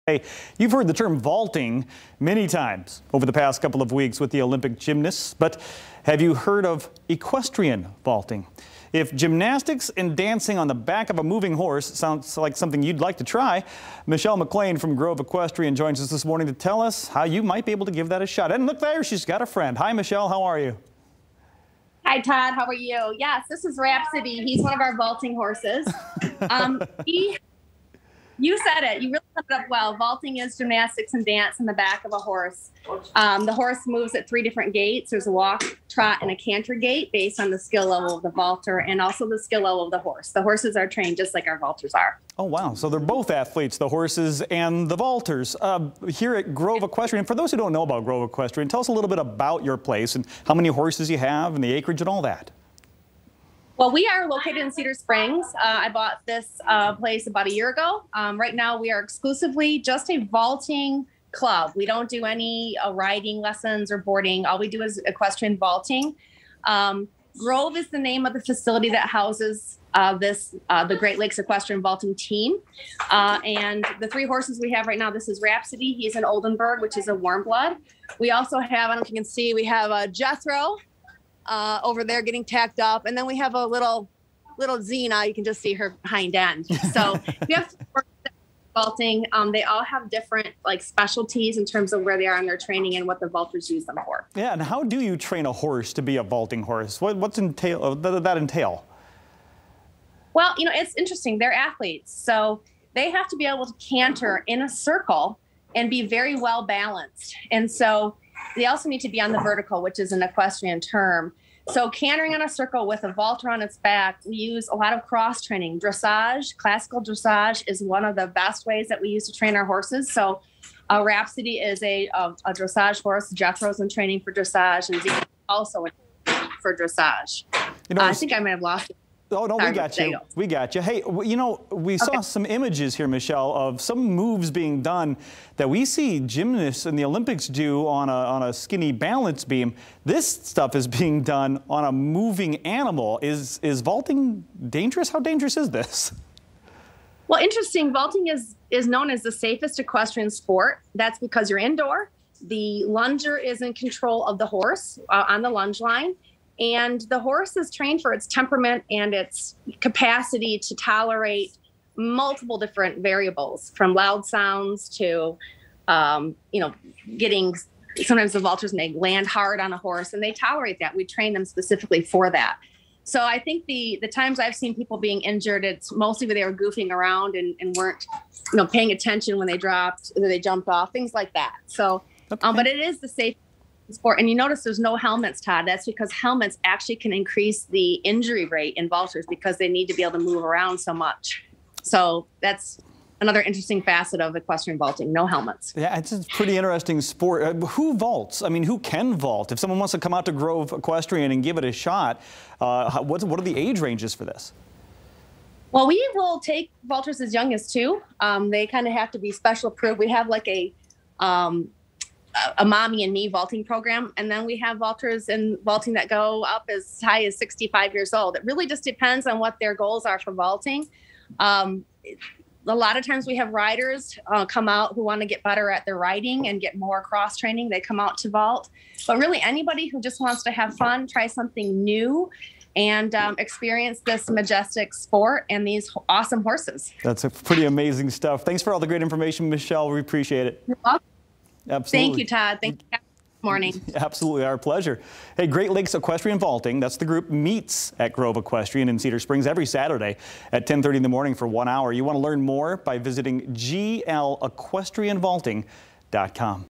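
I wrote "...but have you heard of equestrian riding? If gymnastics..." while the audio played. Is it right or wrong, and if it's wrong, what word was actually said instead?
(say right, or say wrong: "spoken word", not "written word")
wrong: "vaulting", not "riding".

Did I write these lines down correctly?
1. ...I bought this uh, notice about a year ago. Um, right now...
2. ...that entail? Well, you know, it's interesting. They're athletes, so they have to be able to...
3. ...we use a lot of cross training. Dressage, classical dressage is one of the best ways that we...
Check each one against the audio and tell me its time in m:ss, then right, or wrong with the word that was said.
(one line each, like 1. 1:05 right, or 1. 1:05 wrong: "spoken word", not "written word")
1. 0:55 wrong: "place", not "notice"
2. 1:38 right
3. 1:54 right.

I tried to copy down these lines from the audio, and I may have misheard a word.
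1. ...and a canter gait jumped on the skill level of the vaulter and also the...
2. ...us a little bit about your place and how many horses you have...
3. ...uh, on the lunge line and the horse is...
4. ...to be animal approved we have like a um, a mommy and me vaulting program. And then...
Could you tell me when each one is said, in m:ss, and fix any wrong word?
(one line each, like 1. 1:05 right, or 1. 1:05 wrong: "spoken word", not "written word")
1. 0:36 wrong: "based", not "jumped"
2. 0:48 right
3. 2:35 right
4. 3:29 wrong: "special", not "animal".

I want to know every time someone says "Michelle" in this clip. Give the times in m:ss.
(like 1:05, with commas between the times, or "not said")
0:14, 0:19, 2:13, 3:59.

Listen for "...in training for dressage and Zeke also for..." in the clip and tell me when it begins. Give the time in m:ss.
2:03.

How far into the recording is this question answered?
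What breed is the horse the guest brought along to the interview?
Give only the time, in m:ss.
1:16.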